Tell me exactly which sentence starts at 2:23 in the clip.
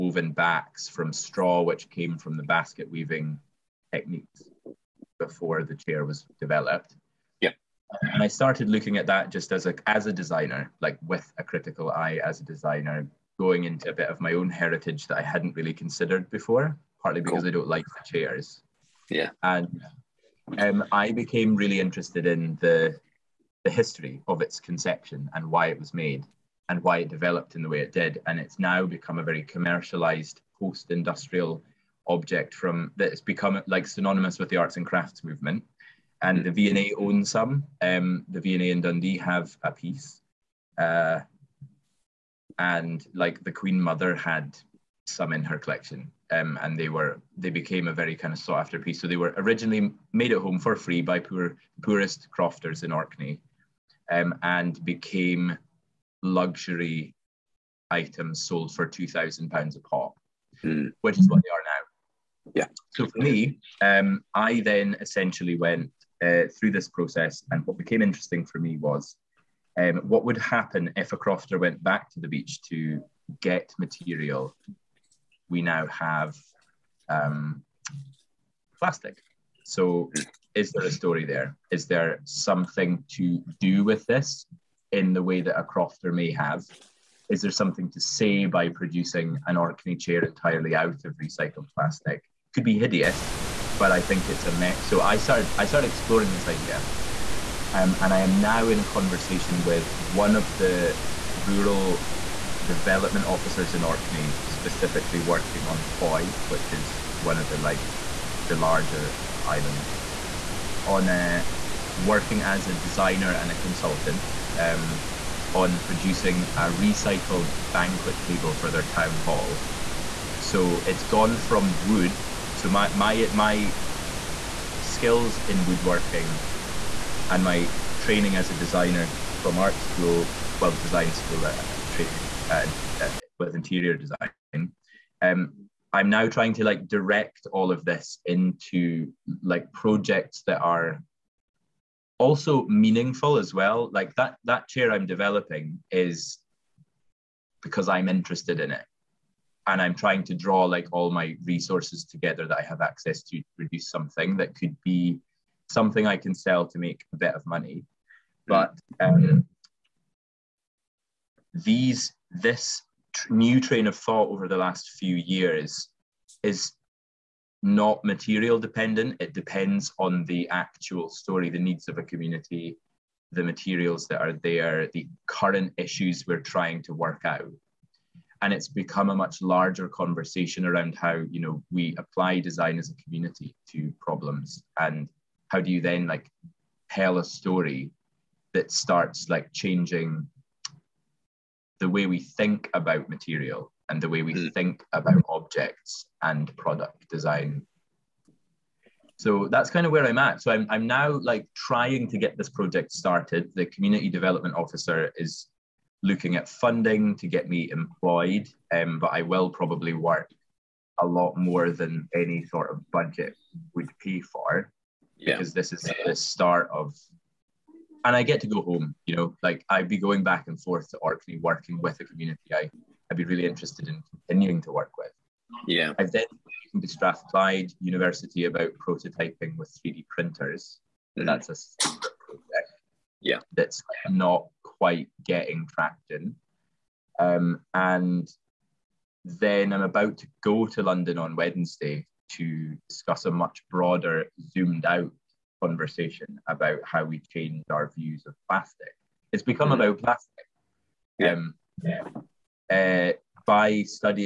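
Like that that chair I'm developing is because I'm interested in it.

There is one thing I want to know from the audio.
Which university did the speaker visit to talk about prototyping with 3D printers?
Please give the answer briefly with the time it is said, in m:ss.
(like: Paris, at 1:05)
Strathclyde University, at 3:46.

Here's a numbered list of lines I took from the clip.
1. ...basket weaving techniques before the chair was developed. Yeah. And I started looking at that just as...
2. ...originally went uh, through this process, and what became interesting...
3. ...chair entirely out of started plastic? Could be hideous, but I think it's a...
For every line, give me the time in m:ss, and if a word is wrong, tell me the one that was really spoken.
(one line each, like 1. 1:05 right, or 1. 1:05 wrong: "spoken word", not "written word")
1. 0:02 right
2. 1:04 wrong: "essentially", not "originally"
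3. 1:29 wrong: "recycled", not "started".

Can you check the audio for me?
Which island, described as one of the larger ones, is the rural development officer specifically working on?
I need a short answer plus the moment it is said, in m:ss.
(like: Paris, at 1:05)
Hoy, at 1:45.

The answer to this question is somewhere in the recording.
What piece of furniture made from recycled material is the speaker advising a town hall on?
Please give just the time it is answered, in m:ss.
1:57.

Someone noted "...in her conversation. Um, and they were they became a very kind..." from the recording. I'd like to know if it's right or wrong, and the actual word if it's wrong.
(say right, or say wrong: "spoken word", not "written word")
wrong: "collection", not "conversation".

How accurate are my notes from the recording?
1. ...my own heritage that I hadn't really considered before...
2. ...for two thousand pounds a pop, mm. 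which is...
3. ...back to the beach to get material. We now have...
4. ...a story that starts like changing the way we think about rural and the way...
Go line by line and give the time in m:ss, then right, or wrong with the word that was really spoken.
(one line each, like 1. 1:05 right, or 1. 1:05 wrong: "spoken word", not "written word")
1. 0:14 right
2. 0:58 right
3. 1:11 right
4. 3:07 wrong: "material", not "rural".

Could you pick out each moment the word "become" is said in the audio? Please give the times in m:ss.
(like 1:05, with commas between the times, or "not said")
0:28, 0:33, 2:58, 4:09.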